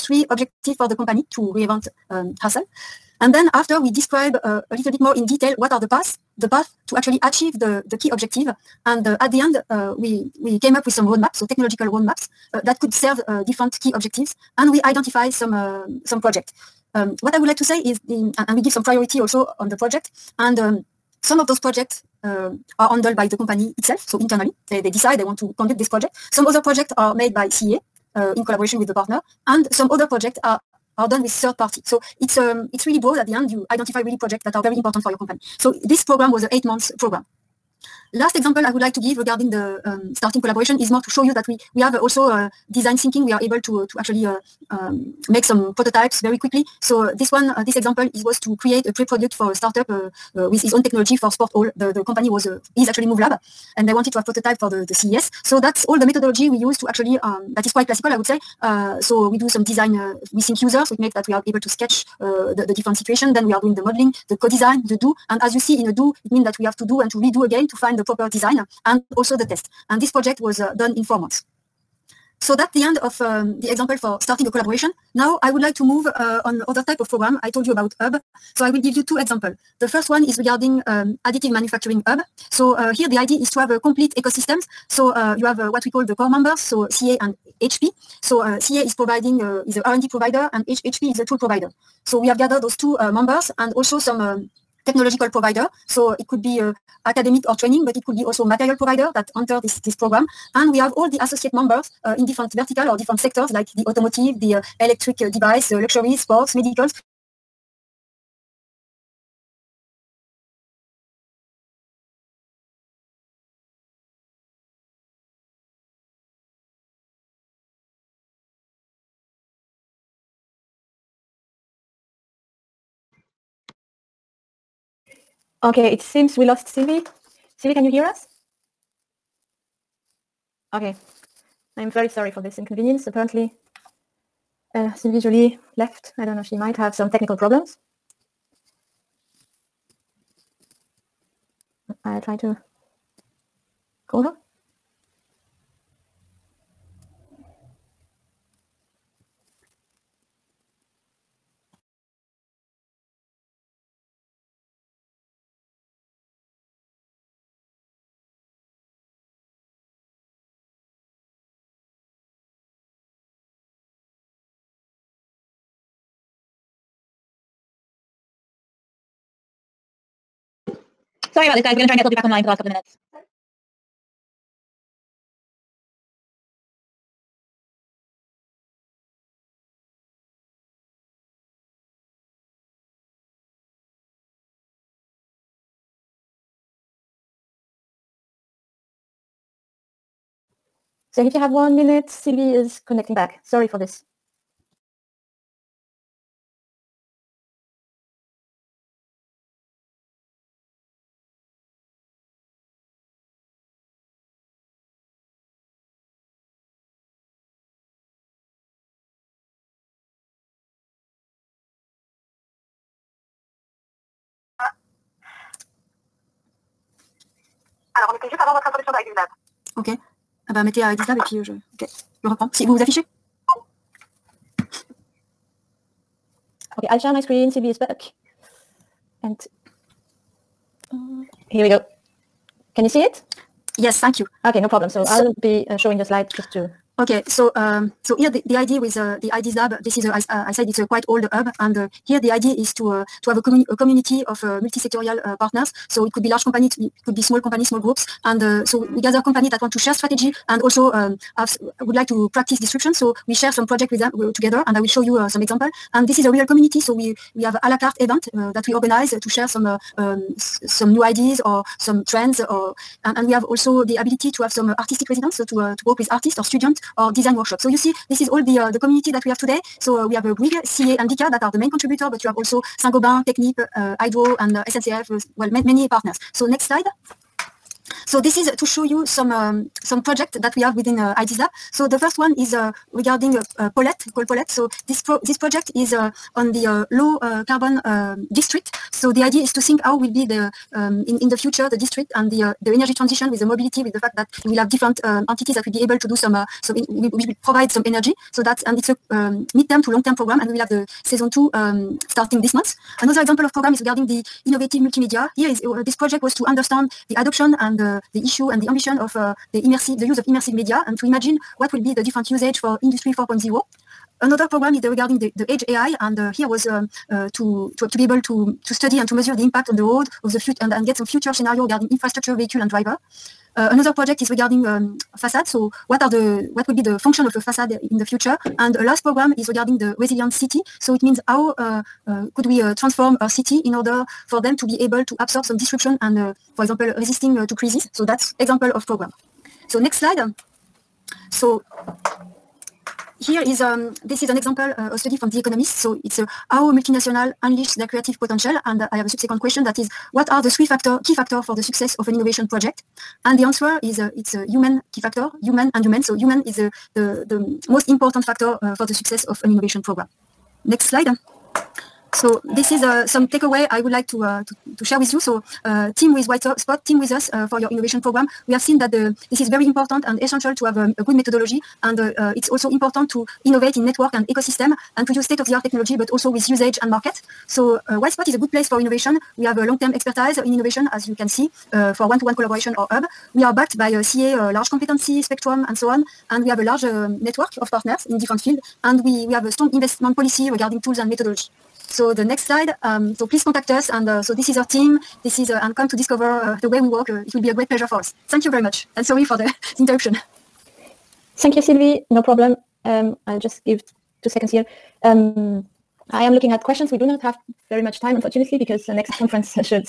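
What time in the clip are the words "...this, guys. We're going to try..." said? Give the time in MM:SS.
02:51.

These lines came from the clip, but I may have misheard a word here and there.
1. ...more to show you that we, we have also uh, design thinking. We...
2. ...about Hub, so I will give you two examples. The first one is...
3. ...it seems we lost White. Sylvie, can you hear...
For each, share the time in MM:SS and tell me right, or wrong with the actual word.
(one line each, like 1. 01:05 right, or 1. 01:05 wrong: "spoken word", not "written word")
1. 00:40 right
2. 01:17 right
3. 02:05 wrong: "Sylvie", not "White".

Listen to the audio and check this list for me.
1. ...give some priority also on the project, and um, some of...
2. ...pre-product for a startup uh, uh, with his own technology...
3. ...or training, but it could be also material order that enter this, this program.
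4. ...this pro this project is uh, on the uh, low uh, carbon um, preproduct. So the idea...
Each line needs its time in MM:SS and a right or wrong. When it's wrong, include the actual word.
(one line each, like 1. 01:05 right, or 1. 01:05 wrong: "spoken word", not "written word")
1. 00:18 right
2. 00:48 right
3. 01:37 wrong: "provider", not "order"
4. 04:44 wrong: "district", not "preproduct".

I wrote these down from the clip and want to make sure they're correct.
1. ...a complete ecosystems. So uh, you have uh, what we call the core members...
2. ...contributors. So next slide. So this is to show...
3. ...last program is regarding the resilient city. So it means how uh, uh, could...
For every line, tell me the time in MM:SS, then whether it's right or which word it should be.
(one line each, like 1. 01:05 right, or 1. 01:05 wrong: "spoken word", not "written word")
1. 01:23 right
2. 04:35 wrong: "partners", not "contributors"
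3. 05:28 right.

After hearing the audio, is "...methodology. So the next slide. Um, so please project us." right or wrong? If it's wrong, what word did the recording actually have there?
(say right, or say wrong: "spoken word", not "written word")
wrong: "contact", not "project".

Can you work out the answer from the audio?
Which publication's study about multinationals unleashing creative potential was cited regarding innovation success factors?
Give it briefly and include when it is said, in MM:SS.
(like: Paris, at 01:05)
The Economist, at 05:45.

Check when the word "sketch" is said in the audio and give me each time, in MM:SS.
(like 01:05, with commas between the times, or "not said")
01:01.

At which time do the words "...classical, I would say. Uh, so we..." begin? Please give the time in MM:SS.
00:57.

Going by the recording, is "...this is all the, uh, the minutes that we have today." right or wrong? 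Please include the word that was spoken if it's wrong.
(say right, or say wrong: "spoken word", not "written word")
wrong: "communities", not "minutes".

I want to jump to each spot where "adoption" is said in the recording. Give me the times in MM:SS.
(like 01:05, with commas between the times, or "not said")
05:07.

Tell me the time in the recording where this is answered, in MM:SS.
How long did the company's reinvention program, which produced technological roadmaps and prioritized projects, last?
00:36.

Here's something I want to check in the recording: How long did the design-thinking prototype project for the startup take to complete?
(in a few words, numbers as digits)
4 months.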